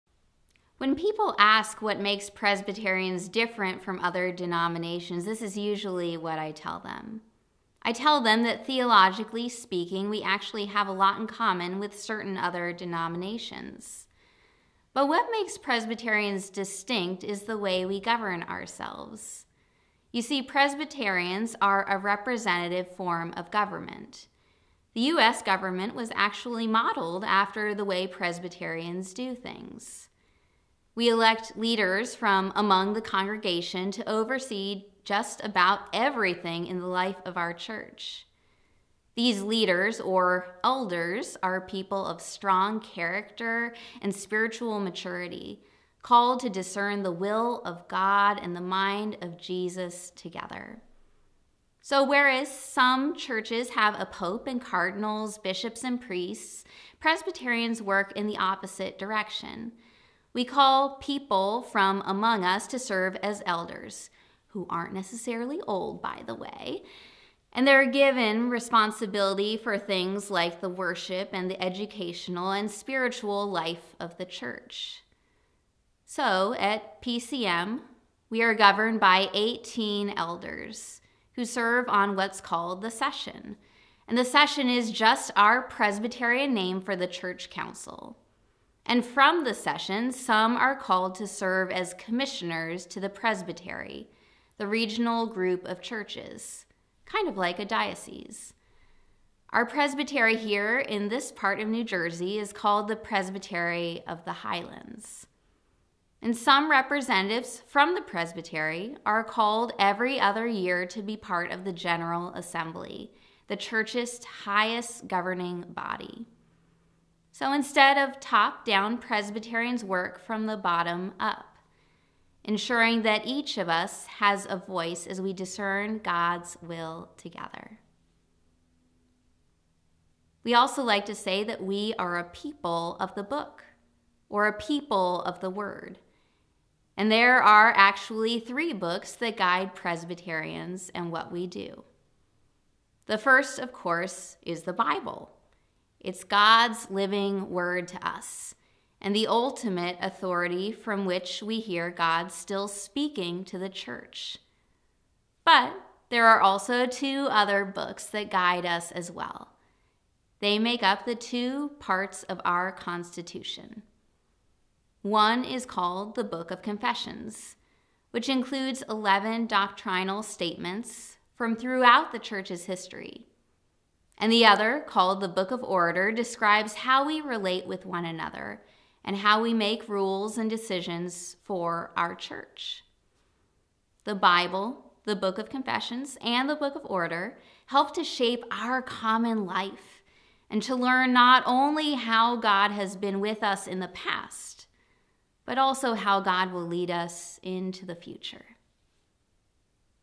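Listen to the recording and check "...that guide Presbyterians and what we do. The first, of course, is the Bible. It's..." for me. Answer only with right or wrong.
right.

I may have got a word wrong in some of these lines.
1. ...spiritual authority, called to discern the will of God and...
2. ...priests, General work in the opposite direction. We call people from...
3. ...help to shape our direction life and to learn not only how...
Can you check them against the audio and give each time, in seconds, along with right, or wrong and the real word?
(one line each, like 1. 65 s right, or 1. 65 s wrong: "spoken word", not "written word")
1. 44 s wrong: "maturity", not "authority"
2. 56 s wrong: "Presbyterians", not "General"
3. 187 s wrong: "common", not "direction".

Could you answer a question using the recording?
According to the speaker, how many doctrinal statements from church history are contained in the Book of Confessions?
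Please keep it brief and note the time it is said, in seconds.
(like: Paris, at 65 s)
11, at 168 s.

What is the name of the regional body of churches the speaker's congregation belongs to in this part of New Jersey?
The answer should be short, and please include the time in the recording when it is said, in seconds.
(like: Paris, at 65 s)
Presbytery of the Highlands, at 102 s.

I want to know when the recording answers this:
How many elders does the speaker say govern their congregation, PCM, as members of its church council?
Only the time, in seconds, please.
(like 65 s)
79 s.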